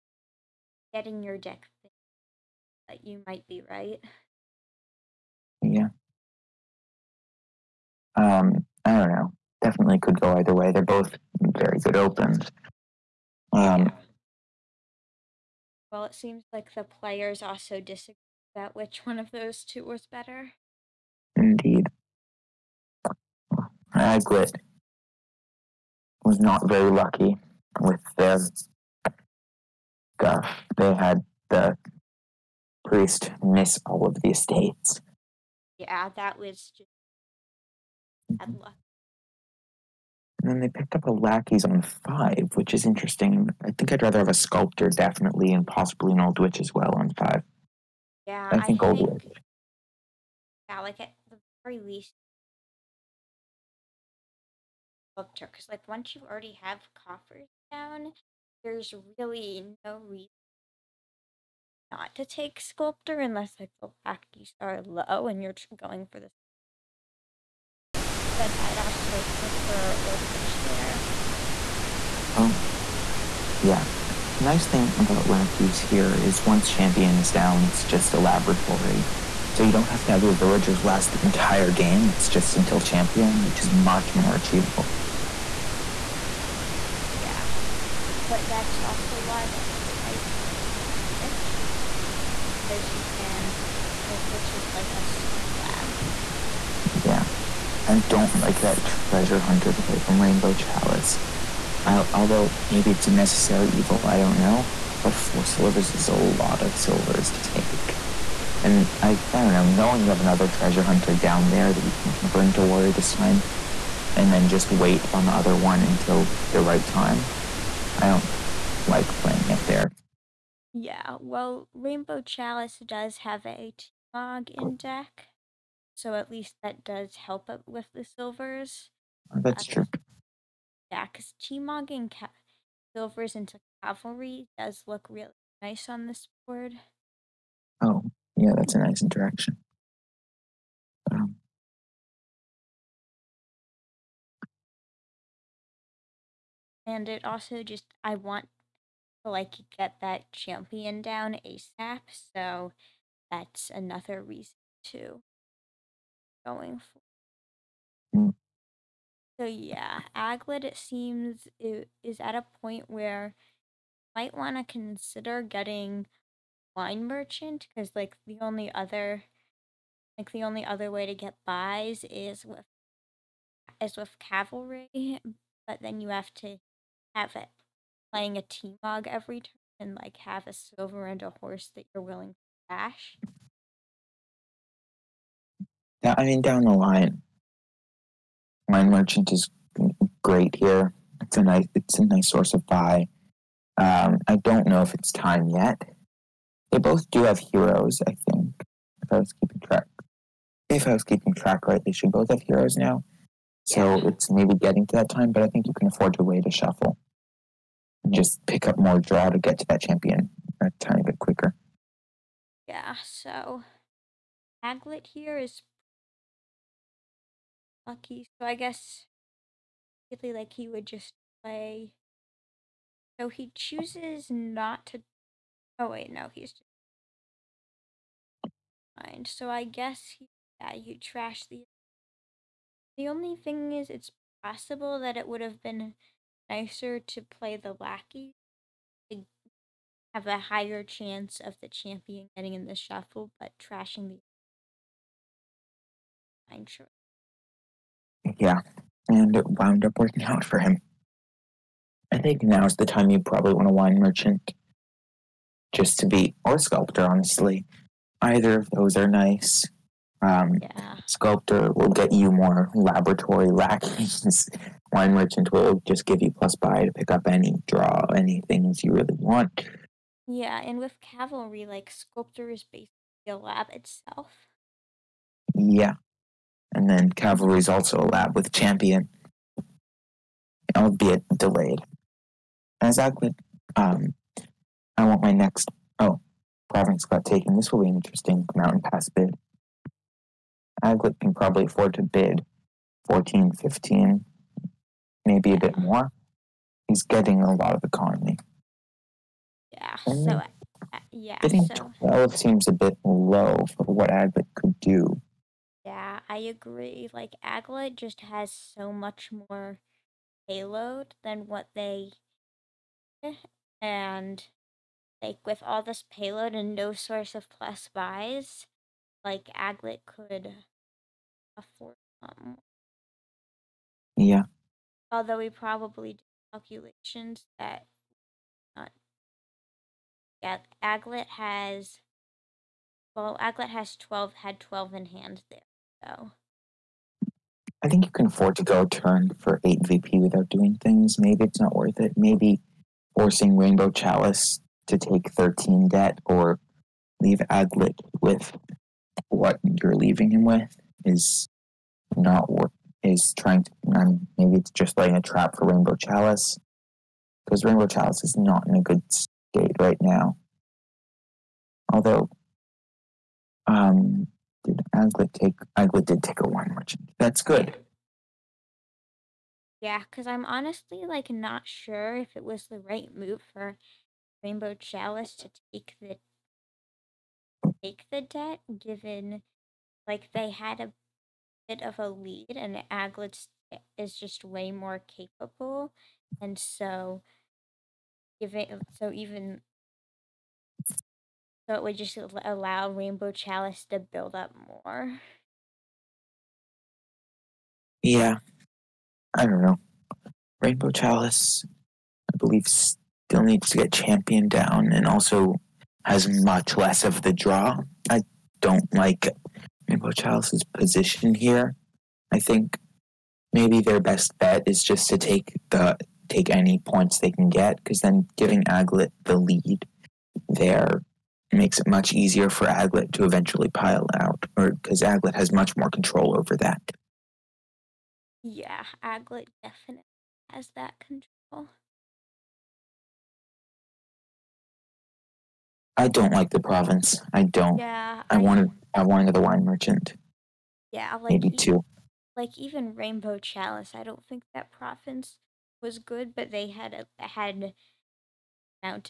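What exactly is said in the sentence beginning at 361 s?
Although, um, did Aglet take Aglet did take a wine merchant?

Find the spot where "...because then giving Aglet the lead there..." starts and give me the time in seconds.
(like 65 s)
417 s.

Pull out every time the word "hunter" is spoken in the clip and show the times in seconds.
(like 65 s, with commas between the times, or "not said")
99 s, 110 s.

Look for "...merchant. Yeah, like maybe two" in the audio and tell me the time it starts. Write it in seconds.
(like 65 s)
439 s.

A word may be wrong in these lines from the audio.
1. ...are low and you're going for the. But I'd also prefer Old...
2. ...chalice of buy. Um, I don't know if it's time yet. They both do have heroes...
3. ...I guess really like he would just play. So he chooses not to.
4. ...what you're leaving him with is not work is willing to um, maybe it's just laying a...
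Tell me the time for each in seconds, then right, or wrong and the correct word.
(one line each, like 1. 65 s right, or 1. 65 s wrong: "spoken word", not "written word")
1. 64 s right
2. 192 s wrong: "source", not "chalice"
3. 218 s right
4. 349 s wrong: "trying", not "willing".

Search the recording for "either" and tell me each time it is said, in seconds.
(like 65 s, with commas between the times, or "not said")
10 s, 258 s.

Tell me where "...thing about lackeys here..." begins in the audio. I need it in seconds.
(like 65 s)
74 s.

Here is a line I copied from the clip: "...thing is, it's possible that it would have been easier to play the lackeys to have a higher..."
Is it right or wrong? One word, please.
wrong.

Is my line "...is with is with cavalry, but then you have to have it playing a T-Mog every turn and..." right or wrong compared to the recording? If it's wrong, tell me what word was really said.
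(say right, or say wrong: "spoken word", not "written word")
right.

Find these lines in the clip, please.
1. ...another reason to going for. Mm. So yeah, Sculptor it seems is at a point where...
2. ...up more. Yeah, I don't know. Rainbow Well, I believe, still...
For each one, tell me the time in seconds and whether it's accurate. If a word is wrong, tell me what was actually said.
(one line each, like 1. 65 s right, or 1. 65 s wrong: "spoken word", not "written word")
1. 153 s wrong: "Aglet", not "Sculptor"
2. 394 s wrong: "Chalice", not "Well".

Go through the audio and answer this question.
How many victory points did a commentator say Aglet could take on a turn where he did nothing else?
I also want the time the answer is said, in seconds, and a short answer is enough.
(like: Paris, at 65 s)
8, at 339 s.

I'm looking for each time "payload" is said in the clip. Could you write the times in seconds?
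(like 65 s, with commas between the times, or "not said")
310 s, 316 s.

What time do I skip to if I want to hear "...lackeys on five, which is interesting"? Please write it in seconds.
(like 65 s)
41 s.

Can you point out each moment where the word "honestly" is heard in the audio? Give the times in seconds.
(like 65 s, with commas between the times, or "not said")
257 s, 370 s.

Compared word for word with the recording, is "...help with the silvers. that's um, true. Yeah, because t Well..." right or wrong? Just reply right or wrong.
wrong.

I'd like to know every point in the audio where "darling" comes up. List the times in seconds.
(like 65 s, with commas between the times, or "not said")
not said.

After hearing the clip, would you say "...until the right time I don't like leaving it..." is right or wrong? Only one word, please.
wrong.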